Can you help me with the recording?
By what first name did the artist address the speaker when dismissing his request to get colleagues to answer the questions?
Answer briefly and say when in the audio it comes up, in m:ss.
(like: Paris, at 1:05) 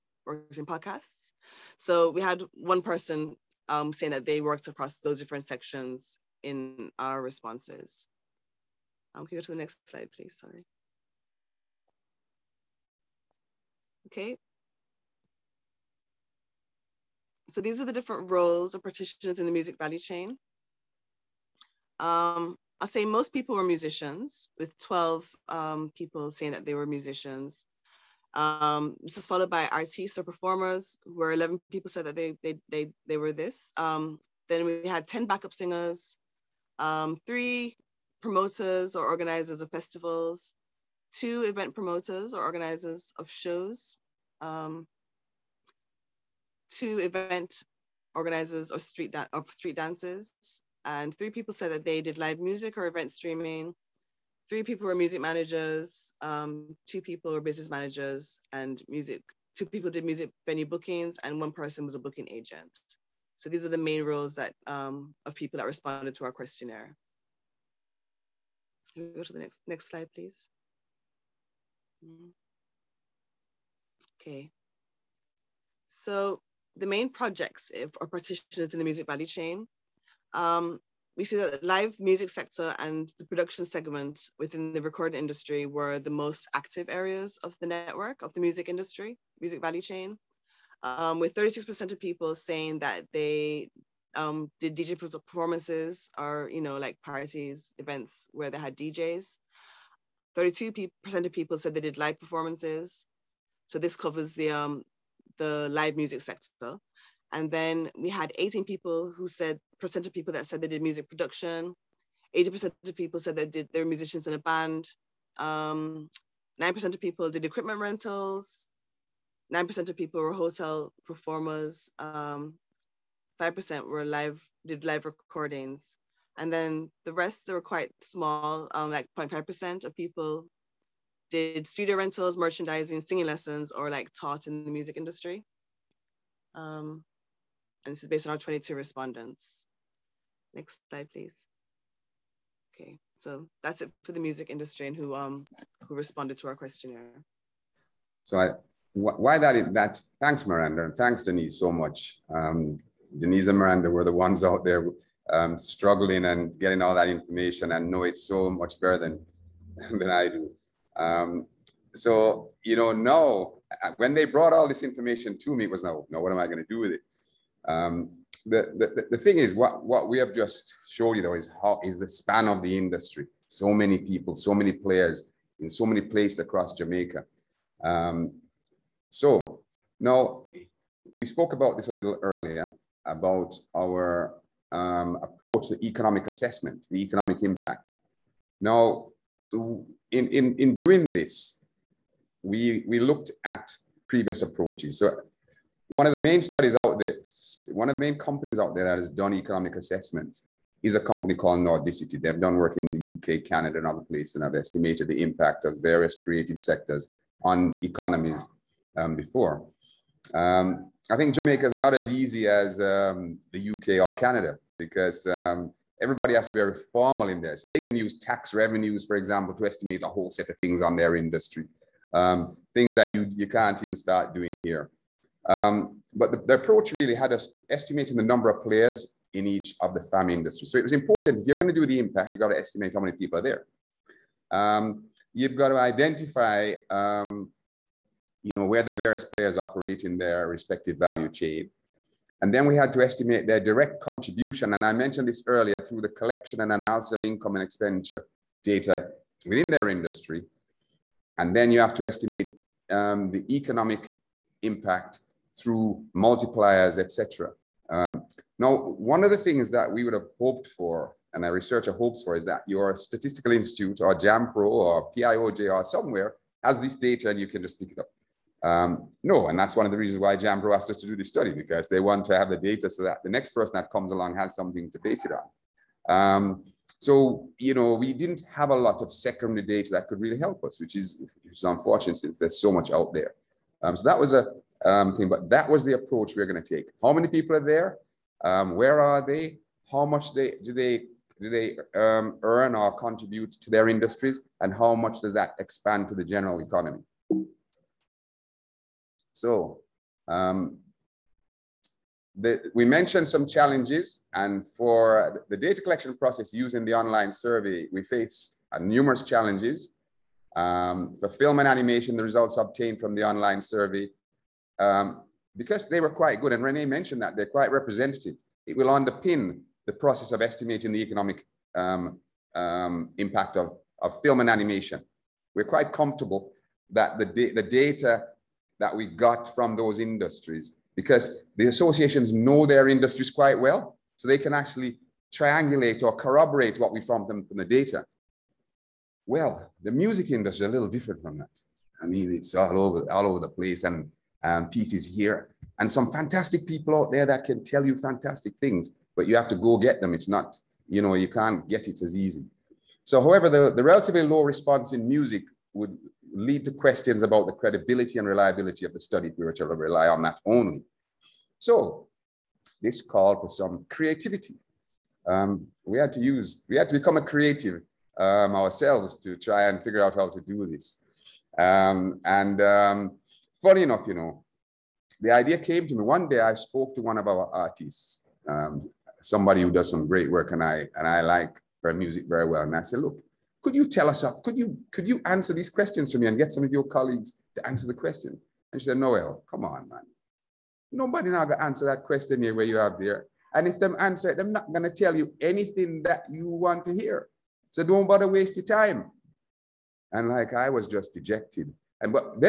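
Noel, at 6:28.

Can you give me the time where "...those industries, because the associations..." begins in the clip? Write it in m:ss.
5:29.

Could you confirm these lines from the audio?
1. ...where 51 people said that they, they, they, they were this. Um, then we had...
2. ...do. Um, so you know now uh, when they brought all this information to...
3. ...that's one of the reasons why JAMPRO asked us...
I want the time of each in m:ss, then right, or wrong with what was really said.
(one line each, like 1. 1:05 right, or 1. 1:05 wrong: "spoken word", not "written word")
1. 0:31 wrong: "11", not "51"
2. 2:40 right
3. 4:29 right.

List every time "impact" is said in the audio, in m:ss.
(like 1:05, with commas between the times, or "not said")
3:07, 3:25, 3:51, 4:14, 5:23.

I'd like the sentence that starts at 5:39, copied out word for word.
Well, the music industry is a little different from that.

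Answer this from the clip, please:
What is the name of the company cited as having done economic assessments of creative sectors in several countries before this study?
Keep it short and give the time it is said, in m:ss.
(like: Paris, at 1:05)
Nordicity, at 3:21.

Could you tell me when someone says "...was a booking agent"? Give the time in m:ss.
1:01.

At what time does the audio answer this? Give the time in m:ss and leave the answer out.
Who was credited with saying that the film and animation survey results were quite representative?
5:16.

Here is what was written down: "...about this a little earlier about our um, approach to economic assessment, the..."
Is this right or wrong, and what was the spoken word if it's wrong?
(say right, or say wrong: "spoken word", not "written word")
right.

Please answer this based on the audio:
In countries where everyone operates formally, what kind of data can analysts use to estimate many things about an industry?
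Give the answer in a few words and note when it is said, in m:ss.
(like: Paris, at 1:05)
Tax revenues, at 3:38.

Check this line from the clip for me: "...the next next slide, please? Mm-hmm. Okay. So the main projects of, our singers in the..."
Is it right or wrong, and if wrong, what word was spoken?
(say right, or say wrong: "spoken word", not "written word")
wrong: "practitioners", not "singers".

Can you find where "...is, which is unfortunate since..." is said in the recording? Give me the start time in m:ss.
4:40.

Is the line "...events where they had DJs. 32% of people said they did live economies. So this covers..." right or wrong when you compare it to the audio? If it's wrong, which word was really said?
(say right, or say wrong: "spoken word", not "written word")
wrong: "performances", not "economies".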